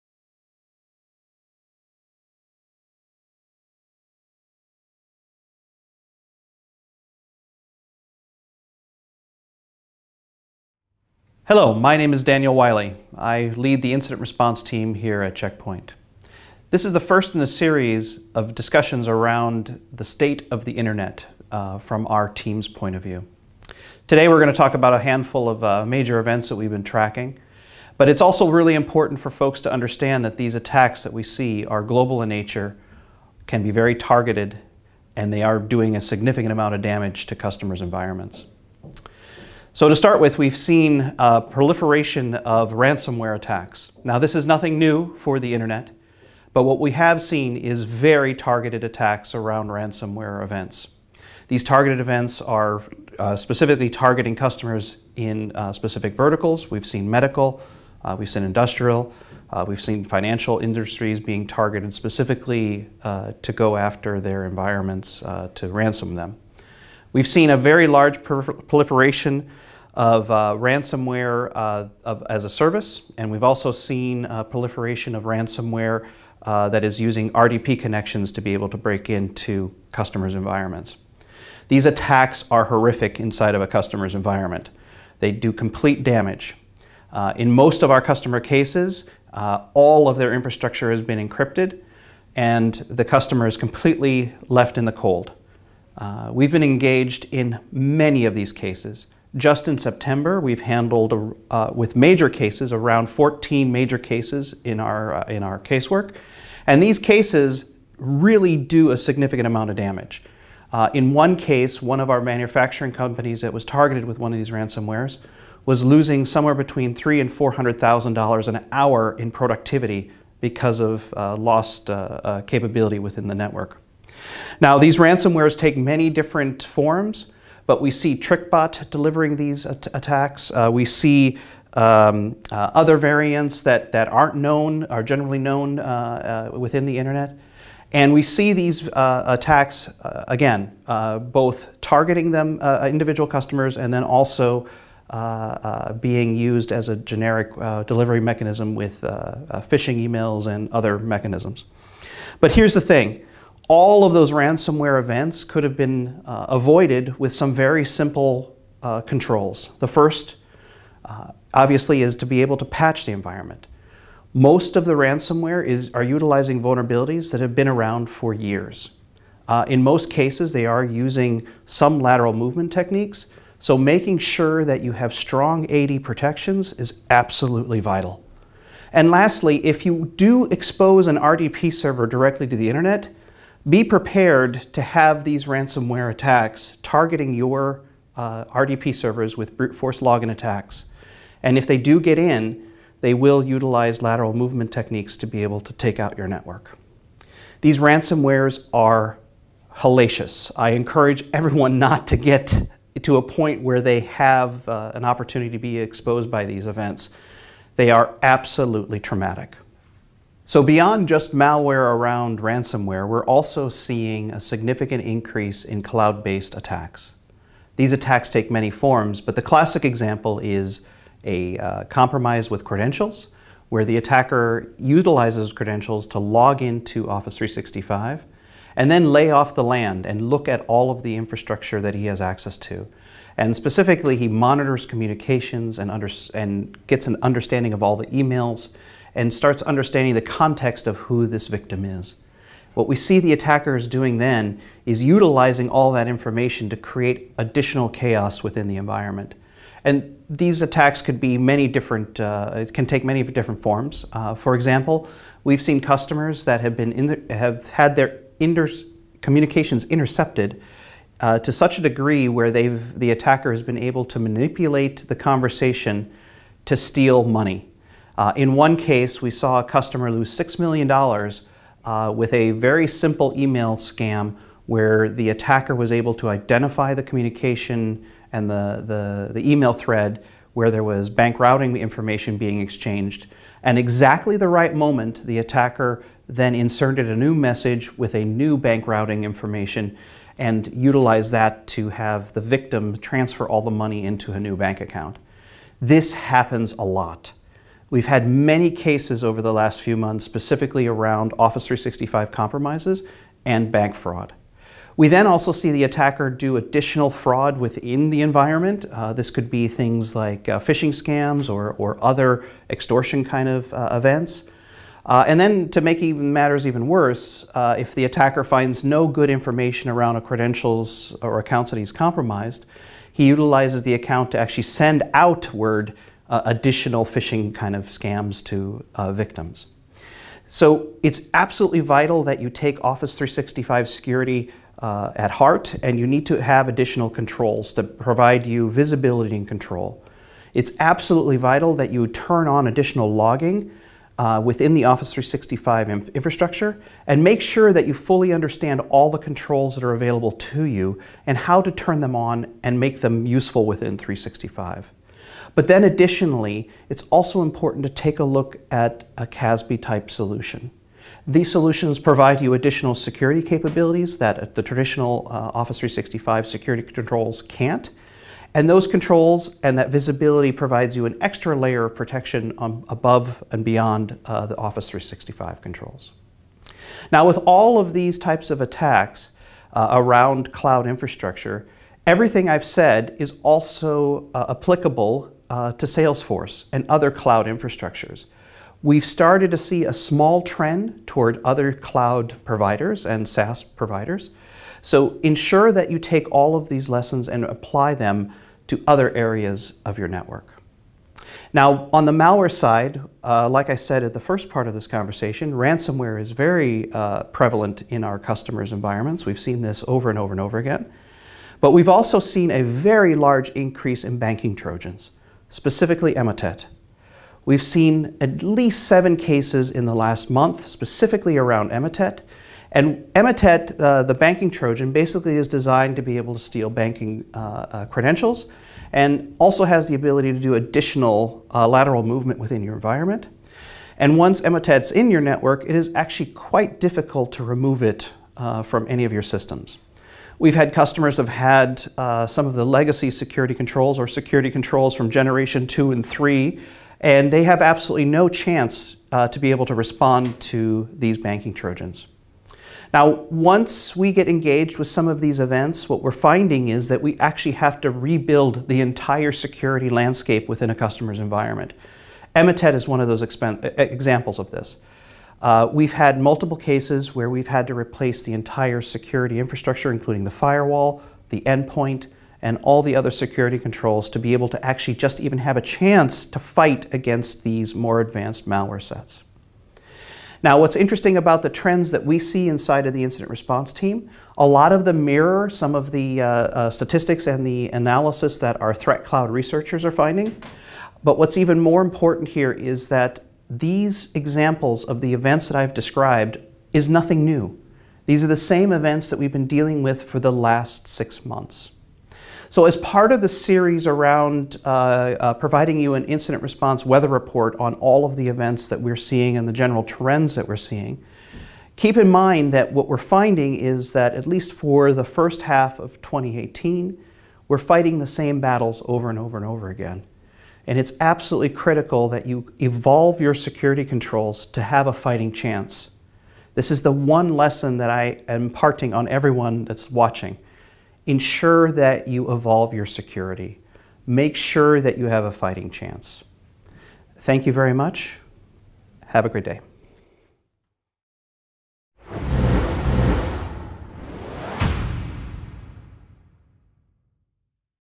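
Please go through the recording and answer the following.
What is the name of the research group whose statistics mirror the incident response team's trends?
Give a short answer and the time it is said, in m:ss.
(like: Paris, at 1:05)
ThreatCloud, at 8:08.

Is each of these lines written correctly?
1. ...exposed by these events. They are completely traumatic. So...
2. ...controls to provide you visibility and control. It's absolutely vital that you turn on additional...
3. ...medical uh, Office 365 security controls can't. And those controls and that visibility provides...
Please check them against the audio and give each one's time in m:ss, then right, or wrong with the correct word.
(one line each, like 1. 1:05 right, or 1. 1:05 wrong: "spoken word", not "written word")
1. 3:25 wrong: "absolutely", not "completely"
2. 5:37 right
3. 6:04 wrong: "traditional", not "medical".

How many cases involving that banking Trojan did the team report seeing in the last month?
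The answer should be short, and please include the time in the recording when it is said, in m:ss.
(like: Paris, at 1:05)
7, at 6:58.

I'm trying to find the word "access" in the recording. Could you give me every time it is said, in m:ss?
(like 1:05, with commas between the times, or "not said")
3:52.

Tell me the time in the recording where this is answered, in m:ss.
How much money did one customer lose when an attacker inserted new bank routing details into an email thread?
4:30.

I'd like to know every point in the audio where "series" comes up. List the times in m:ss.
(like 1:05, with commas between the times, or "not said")
0:17, 8:23.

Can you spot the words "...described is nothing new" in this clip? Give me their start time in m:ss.
8:15.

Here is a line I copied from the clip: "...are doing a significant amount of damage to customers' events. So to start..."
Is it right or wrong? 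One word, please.
wrong.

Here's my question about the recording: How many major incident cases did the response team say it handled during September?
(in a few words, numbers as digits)
14.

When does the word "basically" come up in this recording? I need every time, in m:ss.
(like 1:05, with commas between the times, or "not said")
7:04.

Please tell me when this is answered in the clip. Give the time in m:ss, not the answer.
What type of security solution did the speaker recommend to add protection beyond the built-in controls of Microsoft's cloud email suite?
5:59.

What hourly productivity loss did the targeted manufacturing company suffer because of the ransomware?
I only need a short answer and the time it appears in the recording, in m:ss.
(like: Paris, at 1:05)
$300,000 to $400,000, at 1:56.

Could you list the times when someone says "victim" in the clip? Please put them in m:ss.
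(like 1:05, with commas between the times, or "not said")
4:01, 4:52, 5:29.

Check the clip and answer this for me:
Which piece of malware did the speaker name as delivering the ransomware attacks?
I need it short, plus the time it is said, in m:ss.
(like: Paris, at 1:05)
TrickBot, at 2:08.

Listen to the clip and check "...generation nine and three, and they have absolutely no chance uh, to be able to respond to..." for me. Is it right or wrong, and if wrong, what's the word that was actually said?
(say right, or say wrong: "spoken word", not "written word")
wrong: "two", not "nine".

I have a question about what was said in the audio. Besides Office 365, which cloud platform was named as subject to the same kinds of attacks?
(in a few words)
Salesforce.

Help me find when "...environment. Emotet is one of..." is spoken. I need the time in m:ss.
7:41.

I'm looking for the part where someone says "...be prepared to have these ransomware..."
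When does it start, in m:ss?
3:03.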